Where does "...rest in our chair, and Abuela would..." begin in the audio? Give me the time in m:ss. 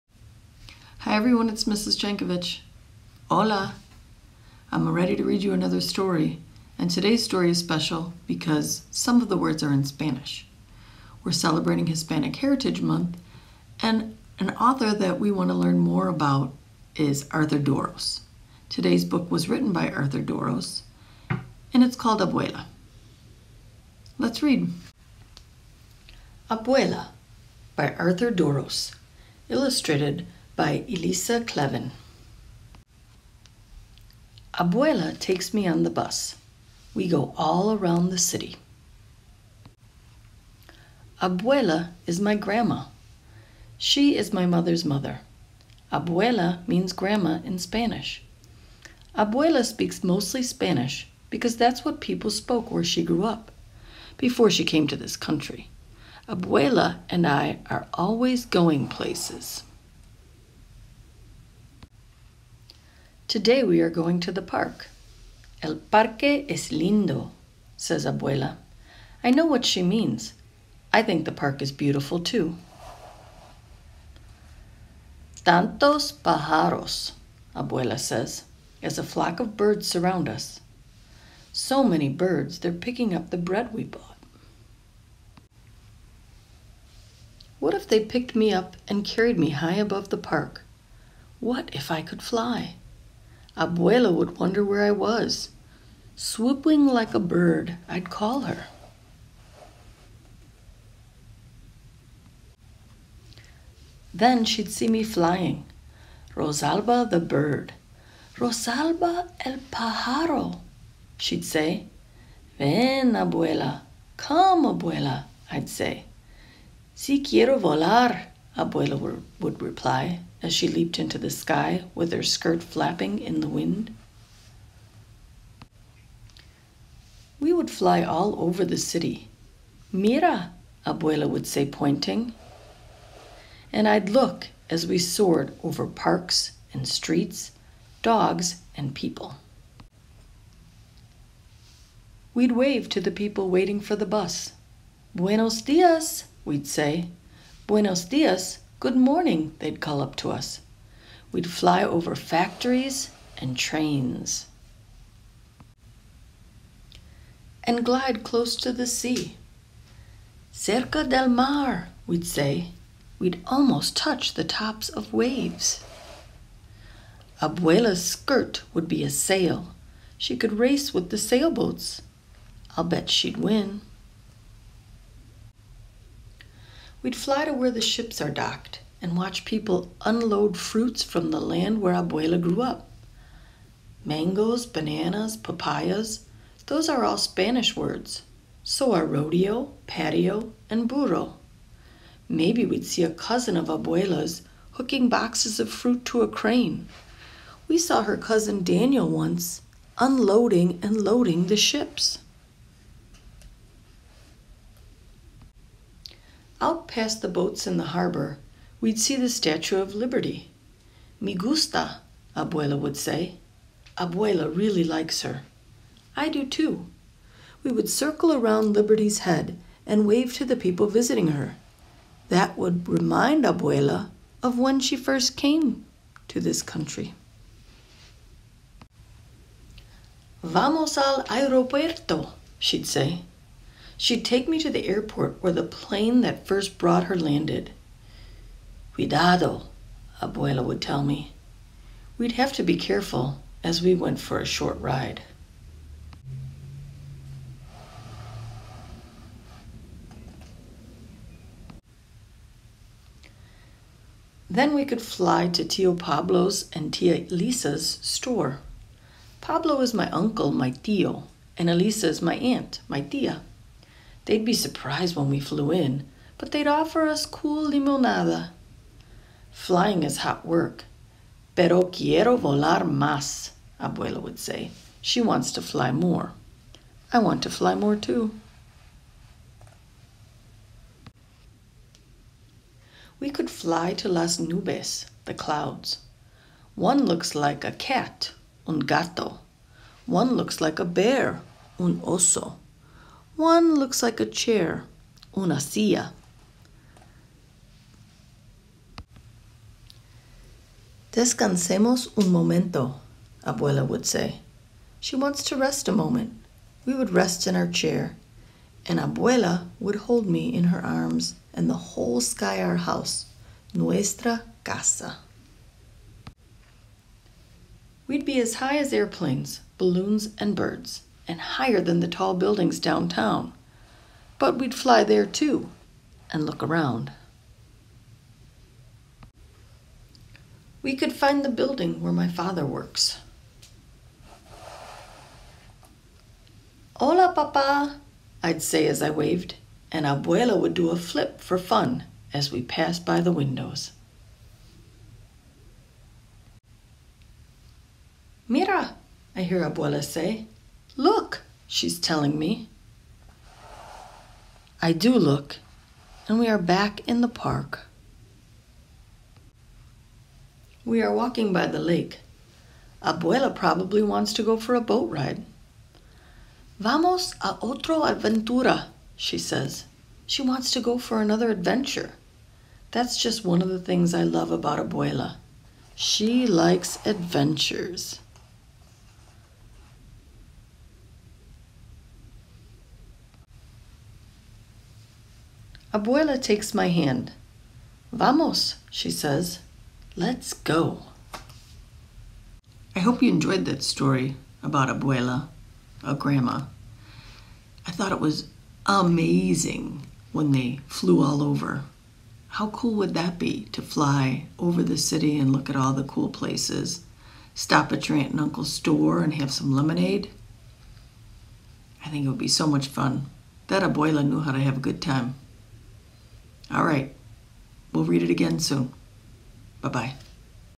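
5:07.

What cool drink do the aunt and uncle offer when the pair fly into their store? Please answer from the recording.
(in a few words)
limonada.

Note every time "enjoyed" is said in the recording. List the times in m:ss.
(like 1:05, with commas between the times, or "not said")
6:33.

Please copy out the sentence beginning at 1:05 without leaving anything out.
El parque es lindo, says Abuela.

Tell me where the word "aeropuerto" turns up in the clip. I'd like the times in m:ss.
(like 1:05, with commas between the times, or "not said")
3:51.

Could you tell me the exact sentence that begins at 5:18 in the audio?
We'd be as high as airplanes, balloons, and birds and higher than the tall buildings downtown.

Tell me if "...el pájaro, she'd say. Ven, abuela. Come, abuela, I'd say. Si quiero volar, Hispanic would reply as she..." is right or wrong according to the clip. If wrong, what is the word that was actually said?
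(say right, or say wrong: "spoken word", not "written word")
wrong: "Abuela", not "Hispanic".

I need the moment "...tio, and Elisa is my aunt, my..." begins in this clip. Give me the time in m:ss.
4:20.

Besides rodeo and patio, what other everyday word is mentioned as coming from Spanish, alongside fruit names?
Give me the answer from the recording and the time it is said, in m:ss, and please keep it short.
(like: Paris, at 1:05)
burro, at 3:10.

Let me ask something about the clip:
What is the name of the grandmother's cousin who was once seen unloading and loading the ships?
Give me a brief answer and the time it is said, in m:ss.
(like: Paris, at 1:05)
Daniel, at 3:18.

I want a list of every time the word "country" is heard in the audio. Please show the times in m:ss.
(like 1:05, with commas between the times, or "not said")
0:55, 3:46.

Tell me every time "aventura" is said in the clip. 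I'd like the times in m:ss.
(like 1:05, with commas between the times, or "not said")
6:08.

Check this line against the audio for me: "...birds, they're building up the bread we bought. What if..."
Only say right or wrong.
wrong.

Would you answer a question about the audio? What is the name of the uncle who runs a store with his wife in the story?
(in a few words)
Tio Pablo.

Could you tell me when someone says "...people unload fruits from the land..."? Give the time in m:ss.
2:59.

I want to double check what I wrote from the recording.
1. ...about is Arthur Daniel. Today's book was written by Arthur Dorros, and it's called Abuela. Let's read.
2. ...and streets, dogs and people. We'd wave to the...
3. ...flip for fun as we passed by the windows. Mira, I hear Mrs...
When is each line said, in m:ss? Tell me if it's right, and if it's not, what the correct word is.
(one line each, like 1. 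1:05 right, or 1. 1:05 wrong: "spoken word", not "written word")
1. 0:16 wrong: "Dorros", not "Daniel"
2. 2:16 right
3. 5:40 wrong: "Abuela", not "Mrs".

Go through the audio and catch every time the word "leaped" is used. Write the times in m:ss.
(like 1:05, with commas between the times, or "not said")
2:00.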